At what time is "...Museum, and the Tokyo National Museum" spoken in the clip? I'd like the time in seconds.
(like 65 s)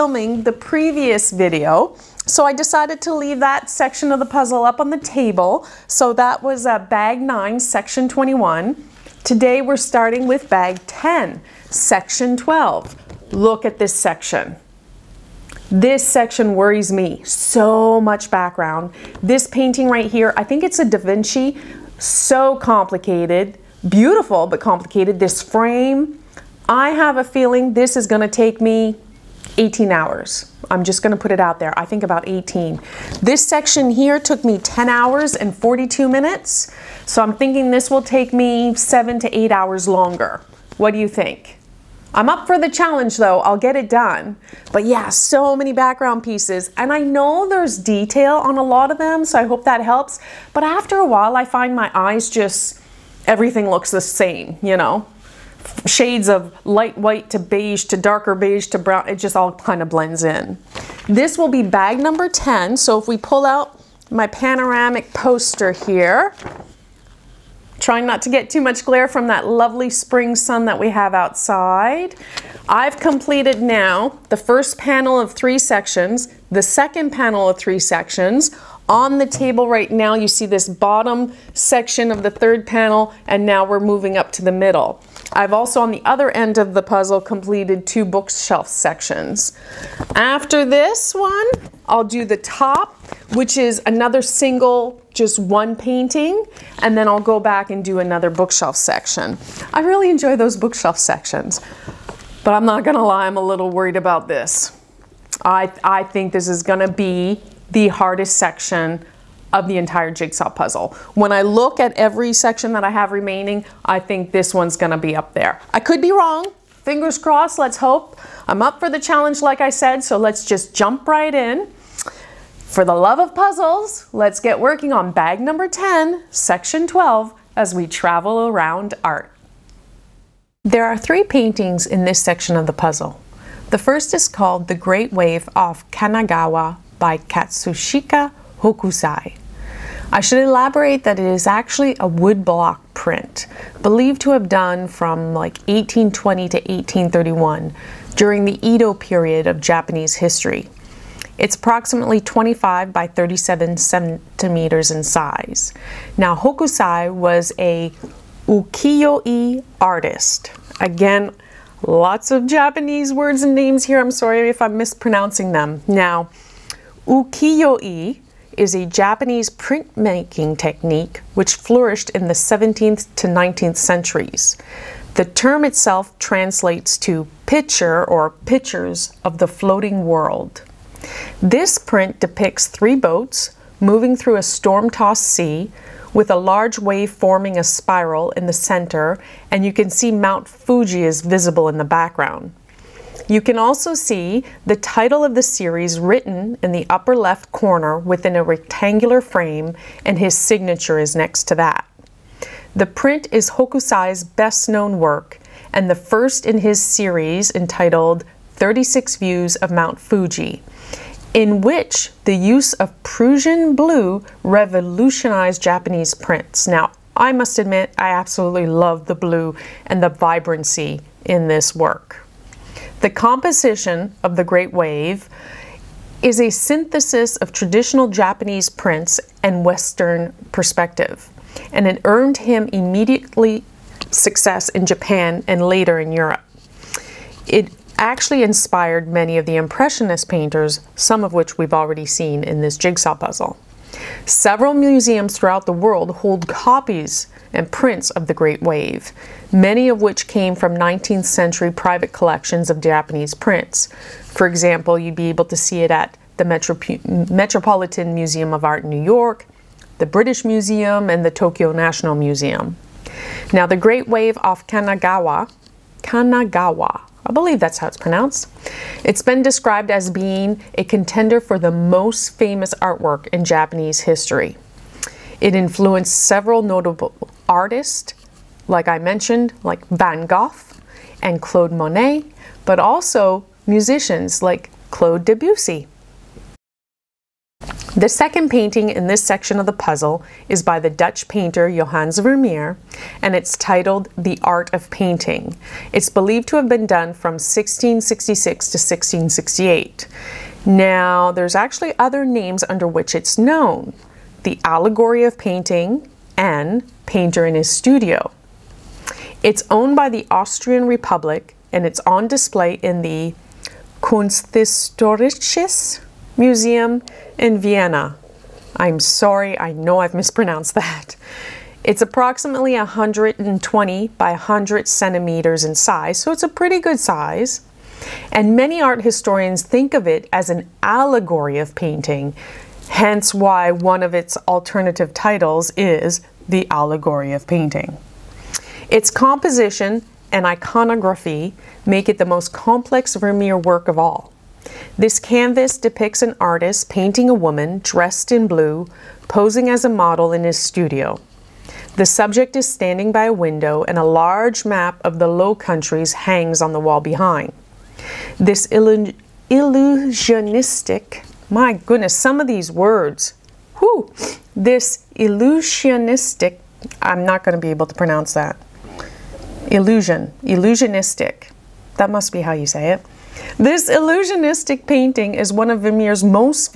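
260 s.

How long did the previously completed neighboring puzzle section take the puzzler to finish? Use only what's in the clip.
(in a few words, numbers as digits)
10 hours 42 minutes.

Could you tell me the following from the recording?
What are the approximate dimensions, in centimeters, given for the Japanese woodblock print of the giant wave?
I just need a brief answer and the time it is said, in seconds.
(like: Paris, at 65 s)
25 by 37 centimeters, at 152 s.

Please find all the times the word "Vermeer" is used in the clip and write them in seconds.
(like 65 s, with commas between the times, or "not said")
292 s, 343 s, 375 s.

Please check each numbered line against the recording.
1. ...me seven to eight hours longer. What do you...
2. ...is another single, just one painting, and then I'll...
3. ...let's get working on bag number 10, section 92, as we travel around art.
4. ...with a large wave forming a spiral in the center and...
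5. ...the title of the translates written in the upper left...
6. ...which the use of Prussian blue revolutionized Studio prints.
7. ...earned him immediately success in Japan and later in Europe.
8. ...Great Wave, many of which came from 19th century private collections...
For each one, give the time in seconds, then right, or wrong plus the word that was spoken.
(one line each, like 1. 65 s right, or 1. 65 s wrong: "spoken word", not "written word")
1. 38 s right
2. 93 s right
3. 124 s wrong: "12", not "92"
4. 186 s right
5. 194 s wrong: "series", not "translates"
6. 211 s wrong: "Japanese", not "Studio"
7. 232 s right
8. 248 s right.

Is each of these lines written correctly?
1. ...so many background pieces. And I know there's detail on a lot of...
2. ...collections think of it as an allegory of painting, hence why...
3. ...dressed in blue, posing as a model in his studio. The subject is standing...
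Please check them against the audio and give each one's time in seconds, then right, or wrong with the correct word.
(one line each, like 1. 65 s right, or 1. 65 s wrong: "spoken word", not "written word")
1. 45 s right
2. 329 s wrong: "historians", not "collections"
3. 347 s right.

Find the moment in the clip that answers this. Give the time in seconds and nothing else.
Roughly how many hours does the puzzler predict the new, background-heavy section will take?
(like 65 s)
32 s.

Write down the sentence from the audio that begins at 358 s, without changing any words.
This illu illusionistic, my goodness, some of these words, whew, this illusionistic, I'm not going to be able to pronounce that.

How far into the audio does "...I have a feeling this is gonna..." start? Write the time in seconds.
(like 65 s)
26 s.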